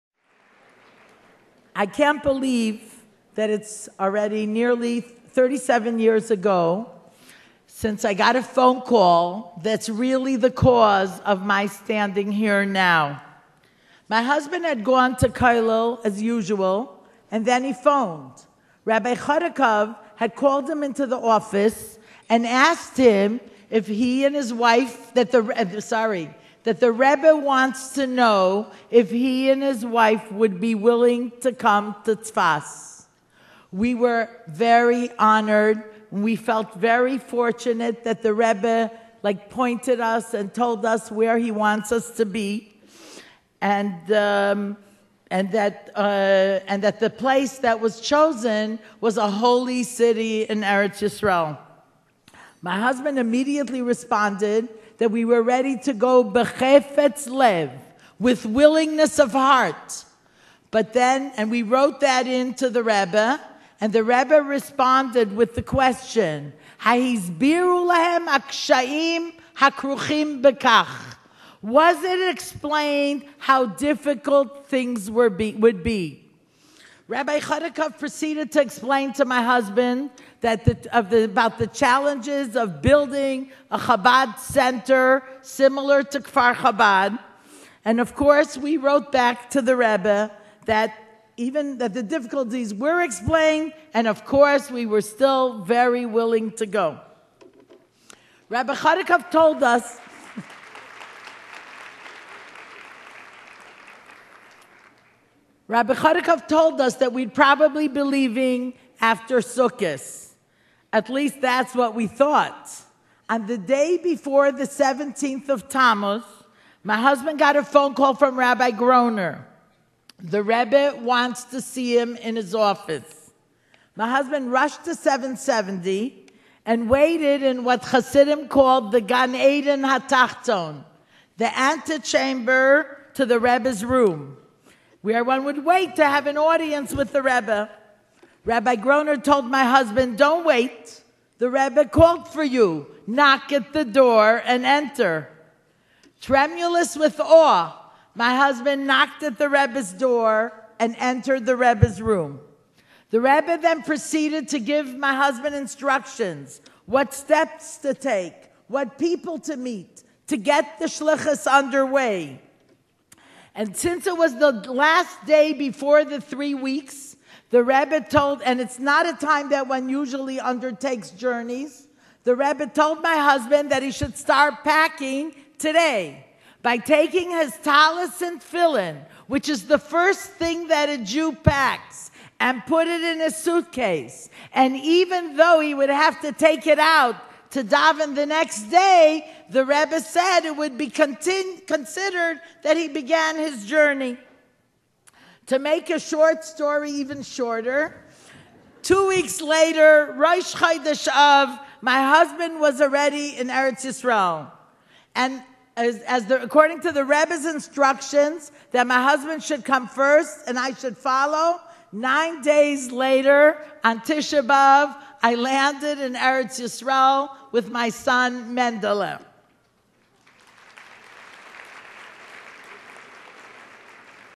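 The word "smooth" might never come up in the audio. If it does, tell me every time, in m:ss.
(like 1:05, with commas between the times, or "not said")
not said.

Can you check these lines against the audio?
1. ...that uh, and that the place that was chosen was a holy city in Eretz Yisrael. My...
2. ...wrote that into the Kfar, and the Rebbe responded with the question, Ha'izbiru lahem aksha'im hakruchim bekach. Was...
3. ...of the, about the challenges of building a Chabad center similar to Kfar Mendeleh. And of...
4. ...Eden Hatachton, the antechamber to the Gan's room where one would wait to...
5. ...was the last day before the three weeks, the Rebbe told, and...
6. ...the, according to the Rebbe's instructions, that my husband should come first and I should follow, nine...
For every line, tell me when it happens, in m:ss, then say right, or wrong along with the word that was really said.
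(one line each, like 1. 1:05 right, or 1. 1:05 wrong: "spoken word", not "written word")
1. 0:45 right
2. 1:01 wrong: "Rebbe", not "Kfar"
3. 1:20 wrong: "Chabad", not "Mendeleh"
4. 2:09 wrong: "Rebbe", not "Gan"
5. 2:44 right
6. 3:26 right.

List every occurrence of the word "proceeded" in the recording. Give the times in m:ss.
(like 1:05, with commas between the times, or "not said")
1:17, 2:33.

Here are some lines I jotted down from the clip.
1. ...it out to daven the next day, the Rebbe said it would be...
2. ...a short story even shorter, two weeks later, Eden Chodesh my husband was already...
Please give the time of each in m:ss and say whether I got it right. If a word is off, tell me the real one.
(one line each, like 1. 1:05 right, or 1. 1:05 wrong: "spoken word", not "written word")
1. 3:06 right
2. 3:15 wrong: "Rosh", not "Eden".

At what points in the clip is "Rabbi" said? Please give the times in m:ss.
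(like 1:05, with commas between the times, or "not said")
0:18, 1:17, 1:38, 1:45, 1:58, 2:18.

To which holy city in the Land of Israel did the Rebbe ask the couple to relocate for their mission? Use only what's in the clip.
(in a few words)
Tzfas.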